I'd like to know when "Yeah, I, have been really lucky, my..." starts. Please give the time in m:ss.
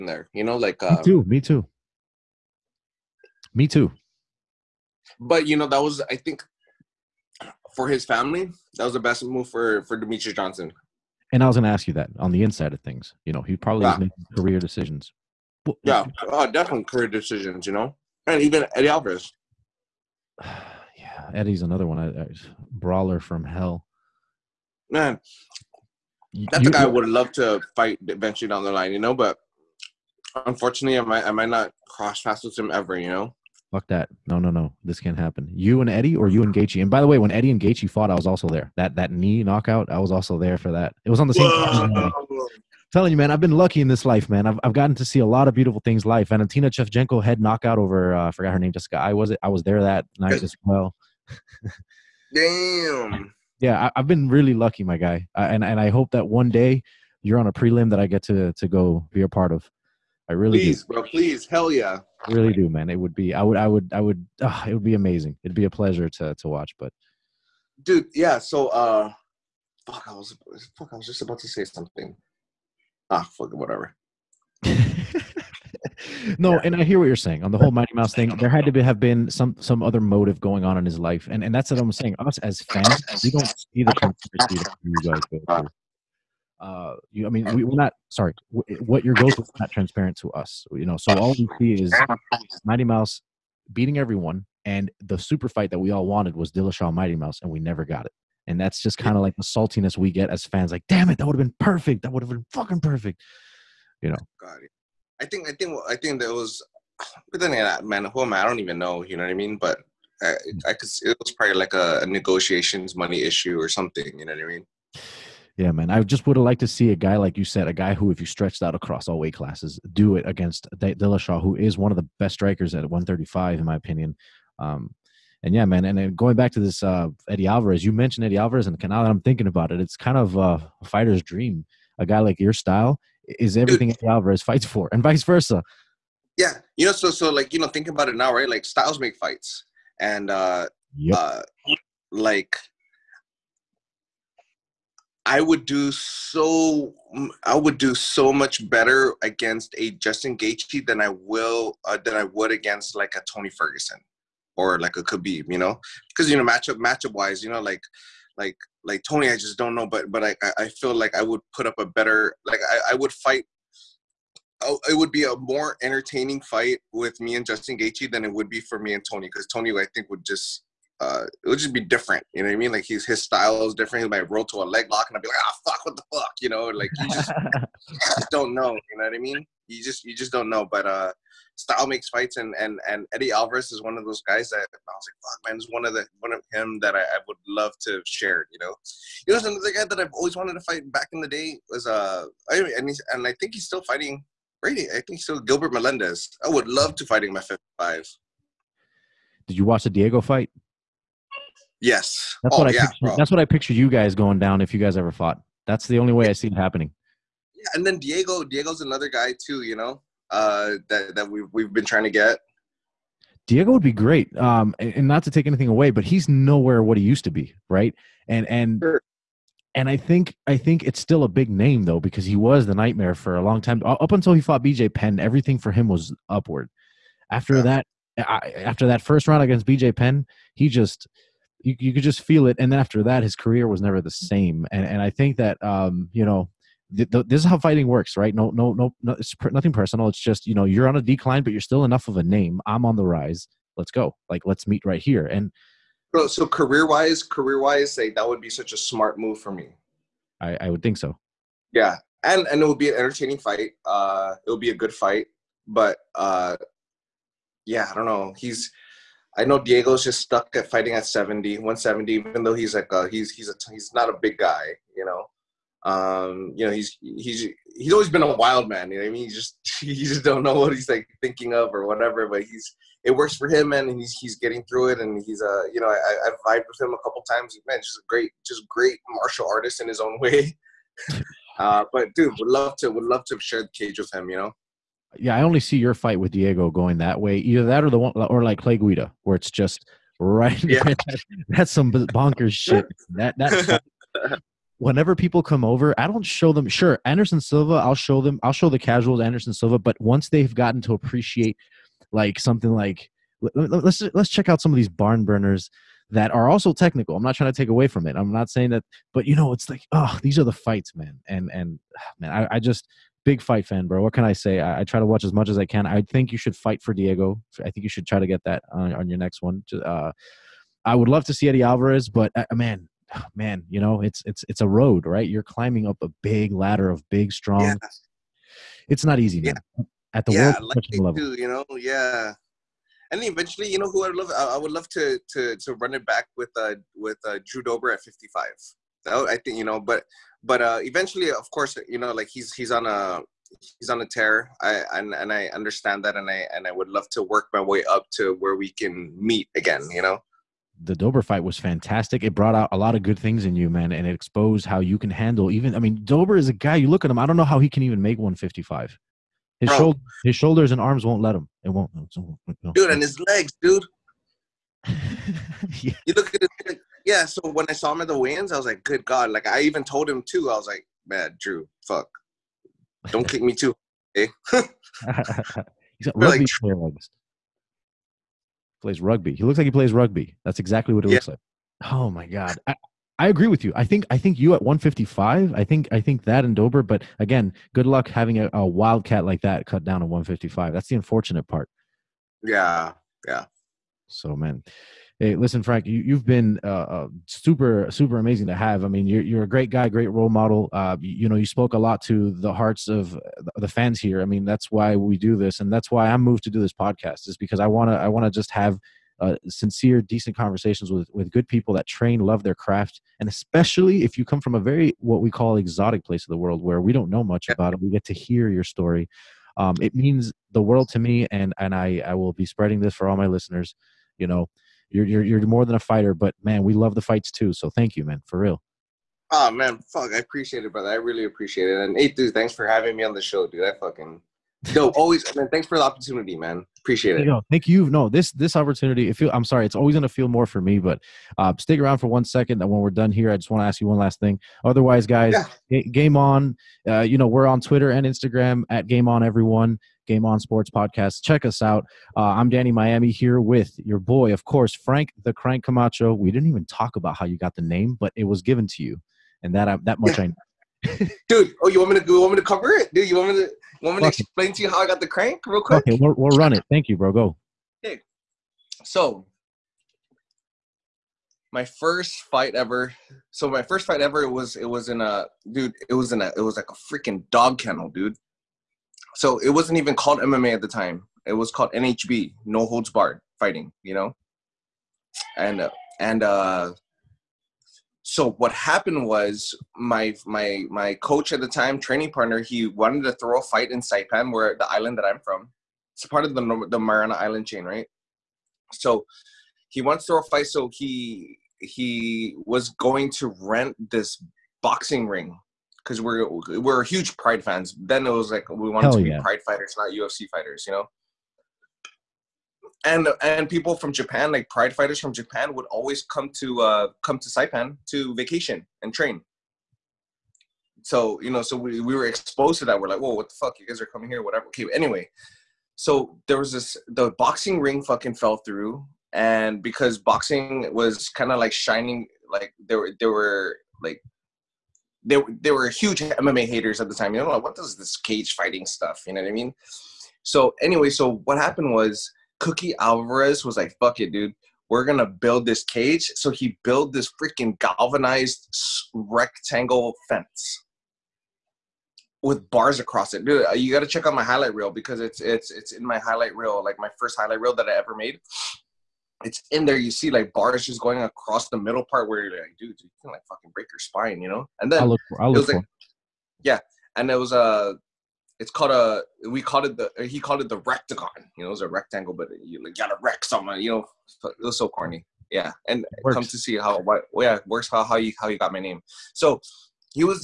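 0:53.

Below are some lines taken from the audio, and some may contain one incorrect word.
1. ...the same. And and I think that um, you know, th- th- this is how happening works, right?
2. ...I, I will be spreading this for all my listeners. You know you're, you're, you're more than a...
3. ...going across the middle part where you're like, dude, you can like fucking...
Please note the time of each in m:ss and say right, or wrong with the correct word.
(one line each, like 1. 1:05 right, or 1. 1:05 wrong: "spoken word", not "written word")
1. 3:54 wrong: "fighting", not "happening"
2. 7:01 right
3. 9:20 right.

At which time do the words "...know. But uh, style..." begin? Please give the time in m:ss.
3:00.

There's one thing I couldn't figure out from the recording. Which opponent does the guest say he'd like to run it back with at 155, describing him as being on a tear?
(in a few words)
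Drew Dober.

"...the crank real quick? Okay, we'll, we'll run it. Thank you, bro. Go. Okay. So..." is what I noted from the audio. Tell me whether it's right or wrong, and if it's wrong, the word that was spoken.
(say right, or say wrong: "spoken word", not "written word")
right.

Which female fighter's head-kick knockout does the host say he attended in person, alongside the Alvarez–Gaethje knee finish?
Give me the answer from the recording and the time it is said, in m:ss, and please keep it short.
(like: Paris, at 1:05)
Valentina Shevchenko, at 0:46.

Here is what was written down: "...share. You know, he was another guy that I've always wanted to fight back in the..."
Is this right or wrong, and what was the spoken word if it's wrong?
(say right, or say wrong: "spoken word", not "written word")
right.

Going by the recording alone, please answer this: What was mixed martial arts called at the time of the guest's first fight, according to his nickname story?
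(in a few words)
No holds barred.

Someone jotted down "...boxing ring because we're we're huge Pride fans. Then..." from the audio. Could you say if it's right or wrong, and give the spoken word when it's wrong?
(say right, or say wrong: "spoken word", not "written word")
right.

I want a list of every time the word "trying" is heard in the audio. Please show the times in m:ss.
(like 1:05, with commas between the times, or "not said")
3:31, 5:07.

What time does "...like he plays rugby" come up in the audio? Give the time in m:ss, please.
6:19.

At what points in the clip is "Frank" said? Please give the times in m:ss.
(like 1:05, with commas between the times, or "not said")
6:35, 7:34.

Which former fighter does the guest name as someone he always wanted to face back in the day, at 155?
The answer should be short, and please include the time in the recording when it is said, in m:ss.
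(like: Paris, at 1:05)
Gilbert Melendez, at 3:15.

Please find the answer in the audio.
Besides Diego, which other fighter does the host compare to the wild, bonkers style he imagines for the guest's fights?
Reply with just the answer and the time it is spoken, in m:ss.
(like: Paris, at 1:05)
Clay Guida, at 4:48.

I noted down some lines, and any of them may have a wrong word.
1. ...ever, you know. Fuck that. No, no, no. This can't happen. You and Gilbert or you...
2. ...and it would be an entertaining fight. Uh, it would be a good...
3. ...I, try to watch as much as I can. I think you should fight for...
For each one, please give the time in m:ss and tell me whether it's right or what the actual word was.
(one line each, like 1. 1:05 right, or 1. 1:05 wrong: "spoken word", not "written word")
1. 0:32 wrong: "Eddie", not "Gilbert"
2. 4:12 right
3. 5:14 right.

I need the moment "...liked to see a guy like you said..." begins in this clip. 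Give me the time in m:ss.
1:56.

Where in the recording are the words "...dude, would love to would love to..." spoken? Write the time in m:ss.
4:42.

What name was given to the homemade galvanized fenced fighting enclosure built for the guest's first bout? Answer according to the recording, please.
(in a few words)
The rectagon.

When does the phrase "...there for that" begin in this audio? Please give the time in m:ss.
0:40.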